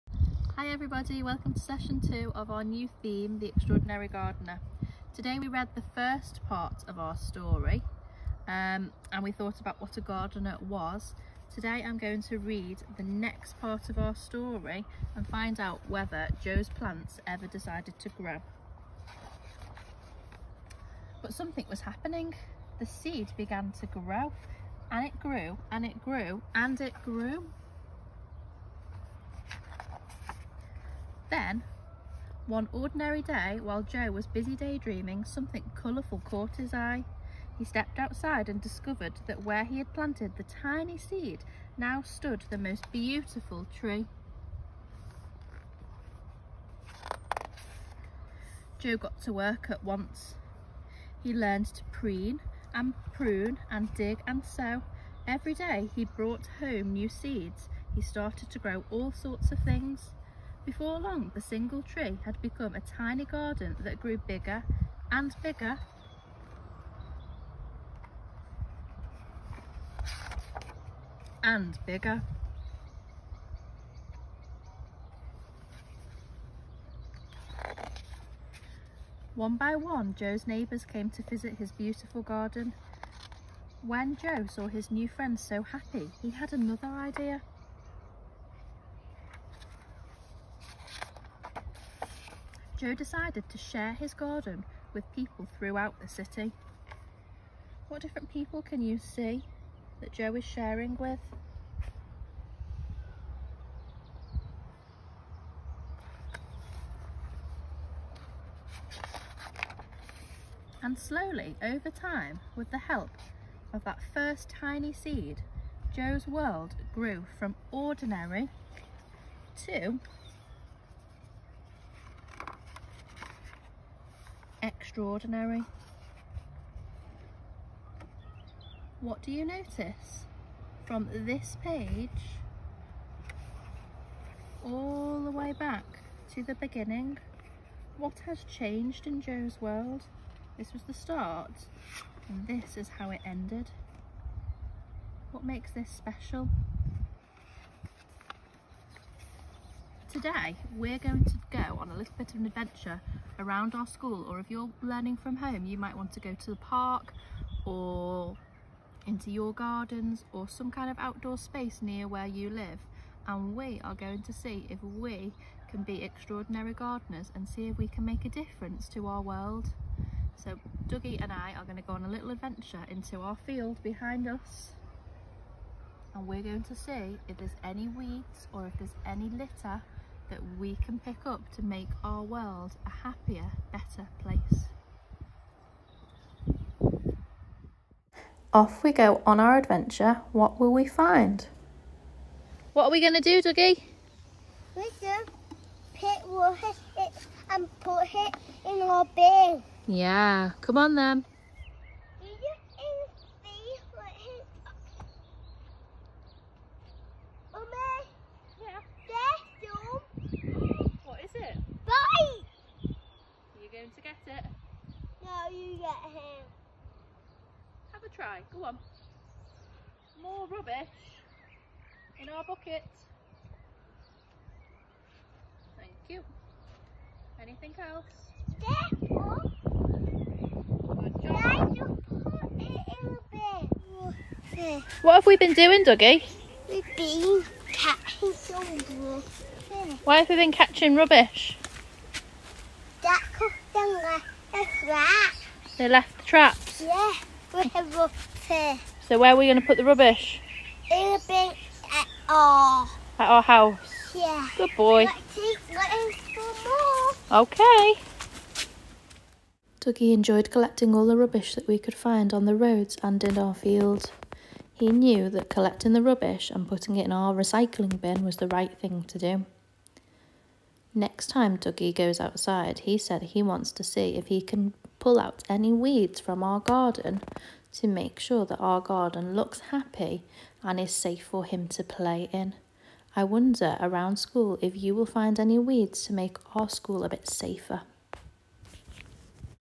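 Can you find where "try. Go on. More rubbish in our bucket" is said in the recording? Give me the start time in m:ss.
3:38.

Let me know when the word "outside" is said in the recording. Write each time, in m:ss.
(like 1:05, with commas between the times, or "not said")
0:37, 4:32.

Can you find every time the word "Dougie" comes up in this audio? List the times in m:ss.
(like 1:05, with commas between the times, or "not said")
2:50, 3:13, 3:55, 4:19, 4:31.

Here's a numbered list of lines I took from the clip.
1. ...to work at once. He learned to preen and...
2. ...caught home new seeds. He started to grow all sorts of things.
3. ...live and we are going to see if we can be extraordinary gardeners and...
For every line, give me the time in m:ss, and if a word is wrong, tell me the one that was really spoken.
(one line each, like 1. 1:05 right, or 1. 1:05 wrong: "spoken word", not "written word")
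1. 0:49 right
2. 0:56 wrong: "brought", not "caught"
3. 2:42 right.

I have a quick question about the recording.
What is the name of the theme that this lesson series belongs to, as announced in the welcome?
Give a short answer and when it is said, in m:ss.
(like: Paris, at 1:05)
The Extraordinary Gardener, at 0:03.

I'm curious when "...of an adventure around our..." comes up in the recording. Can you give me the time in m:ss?
2:32.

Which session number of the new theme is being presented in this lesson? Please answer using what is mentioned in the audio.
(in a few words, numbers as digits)
2.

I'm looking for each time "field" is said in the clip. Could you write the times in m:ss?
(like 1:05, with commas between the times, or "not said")
2:53, 4:23.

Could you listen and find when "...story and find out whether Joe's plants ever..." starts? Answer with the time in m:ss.
0:14.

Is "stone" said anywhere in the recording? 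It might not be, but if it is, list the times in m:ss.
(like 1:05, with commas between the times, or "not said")
not said.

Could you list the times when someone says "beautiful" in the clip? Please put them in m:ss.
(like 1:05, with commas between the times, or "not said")
0:42, 1:21.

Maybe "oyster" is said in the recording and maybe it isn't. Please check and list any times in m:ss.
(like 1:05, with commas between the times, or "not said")
not said.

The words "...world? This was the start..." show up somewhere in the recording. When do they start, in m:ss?
2:19.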